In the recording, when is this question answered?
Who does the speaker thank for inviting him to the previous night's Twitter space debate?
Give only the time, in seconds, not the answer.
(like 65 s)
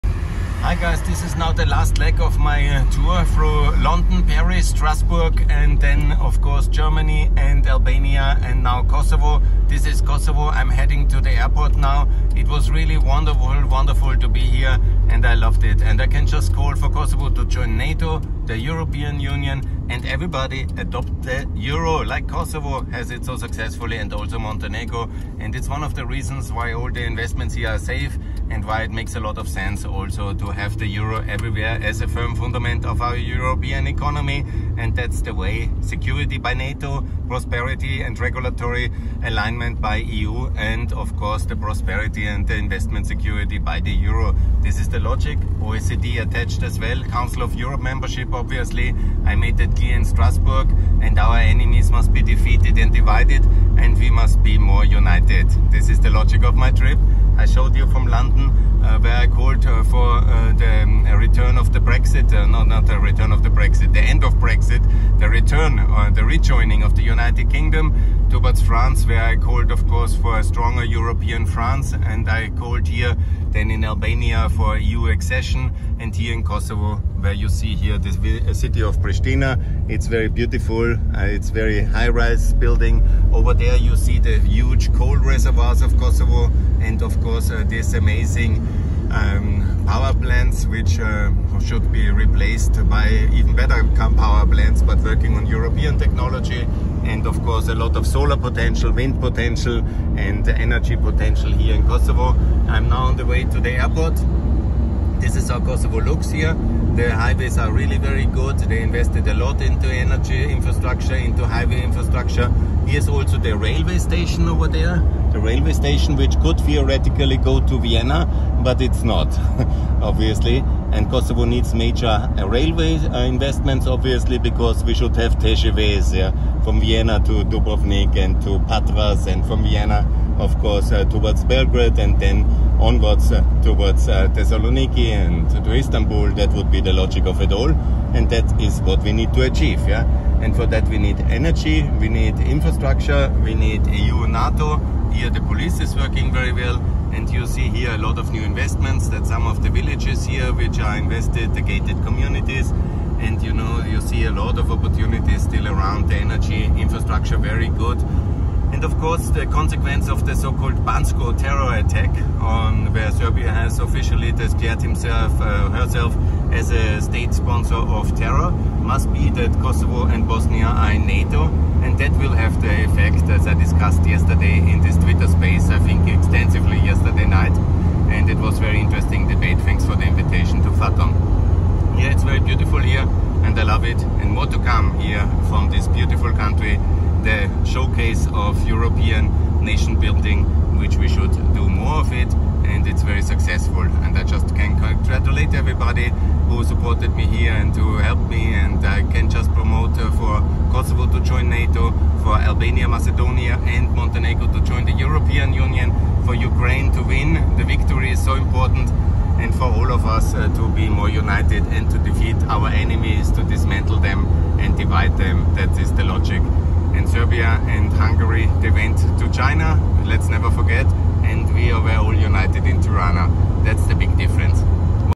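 180 s.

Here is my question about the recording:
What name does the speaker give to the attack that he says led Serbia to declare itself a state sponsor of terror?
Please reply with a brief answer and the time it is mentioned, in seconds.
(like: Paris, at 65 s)
Banjska terror attack, at 160 s.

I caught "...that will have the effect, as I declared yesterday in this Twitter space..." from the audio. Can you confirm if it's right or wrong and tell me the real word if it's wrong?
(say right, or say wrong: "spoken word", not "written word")
wrong: "discussed", not "declared".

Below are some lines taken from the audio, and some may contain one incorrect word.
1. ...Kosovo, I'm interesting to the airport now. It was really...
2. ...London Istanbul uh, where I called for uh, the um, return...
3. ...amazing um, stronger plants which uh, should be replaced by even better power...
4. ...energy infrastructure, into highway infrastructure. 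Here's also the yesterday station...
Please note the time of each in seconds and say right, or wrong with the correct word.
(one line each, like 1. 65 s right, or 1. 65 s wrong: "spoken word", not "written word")
1. 10 s wrong: "heading", not "interesting"
2. 58 s wrong: "Britain", not "Istanbul"
3. 87 s wrong: "power", not "stronger"
4. 109 s wrong: "railway", not "yesterday".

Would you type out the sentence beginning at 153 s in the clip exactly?
And you know, you see a lot of opportunities still around the energy infrastructure, very good.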